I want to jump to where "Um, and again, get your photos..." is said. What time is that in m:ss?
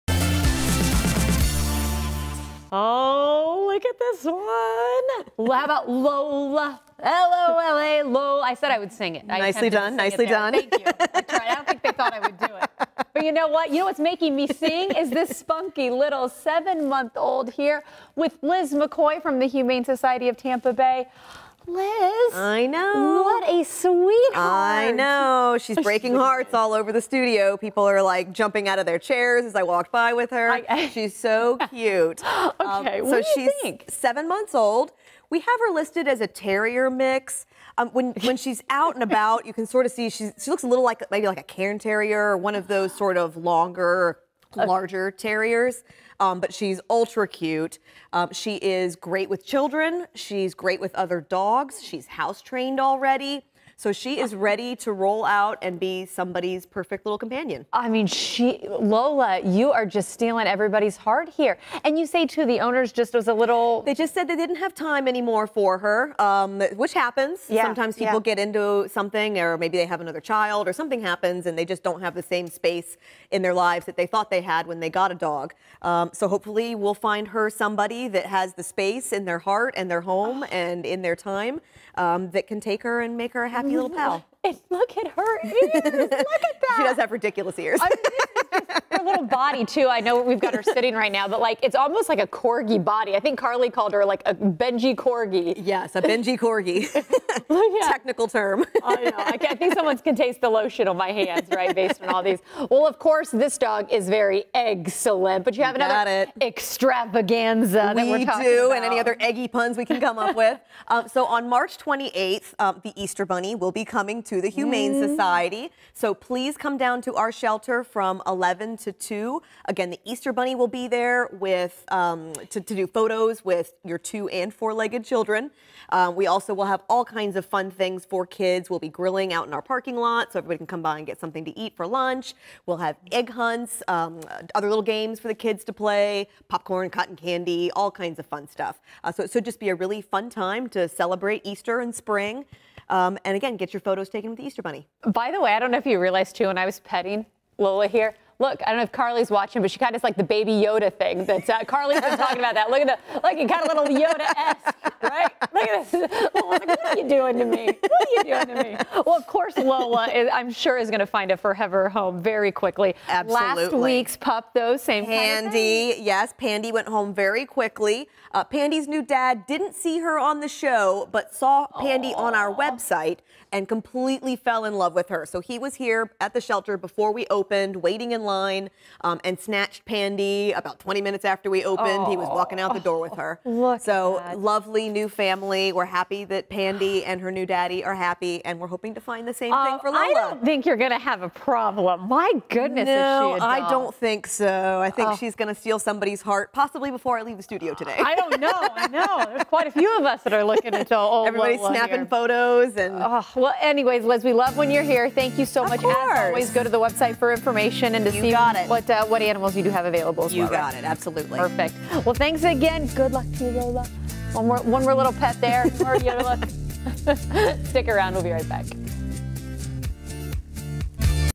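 2:22.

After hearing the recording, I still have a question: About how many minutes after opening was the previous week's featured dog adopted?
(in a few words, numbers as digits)
20.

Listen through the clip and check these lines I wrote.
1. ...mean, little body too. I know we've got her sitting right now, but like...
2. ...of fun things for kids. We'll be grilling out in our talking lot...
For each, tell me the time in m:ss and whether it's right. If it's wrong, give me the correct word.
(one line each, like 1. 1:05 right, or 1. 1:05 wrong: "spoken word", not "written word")
1. 1:27 right
2. 2:07 wrong: "parking", not "talking".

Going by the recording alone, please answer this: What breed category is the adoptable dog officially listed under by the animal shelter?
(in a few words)
Terrier mix.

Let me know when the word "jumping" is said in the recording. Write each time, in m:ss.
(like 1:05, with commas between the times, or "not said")
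0:28.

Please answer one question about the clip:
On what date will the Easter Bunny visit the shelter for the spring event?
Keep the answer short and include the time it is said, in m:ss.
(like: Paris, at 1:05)
March 28, at 1:51.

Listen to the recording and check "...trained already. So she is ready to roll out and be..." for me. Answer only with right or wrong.
right.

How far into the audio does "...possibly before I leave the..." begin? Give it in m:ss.
3:16.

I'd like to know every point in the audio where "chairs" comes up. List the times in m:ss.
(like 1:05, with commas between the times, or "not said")
0:28.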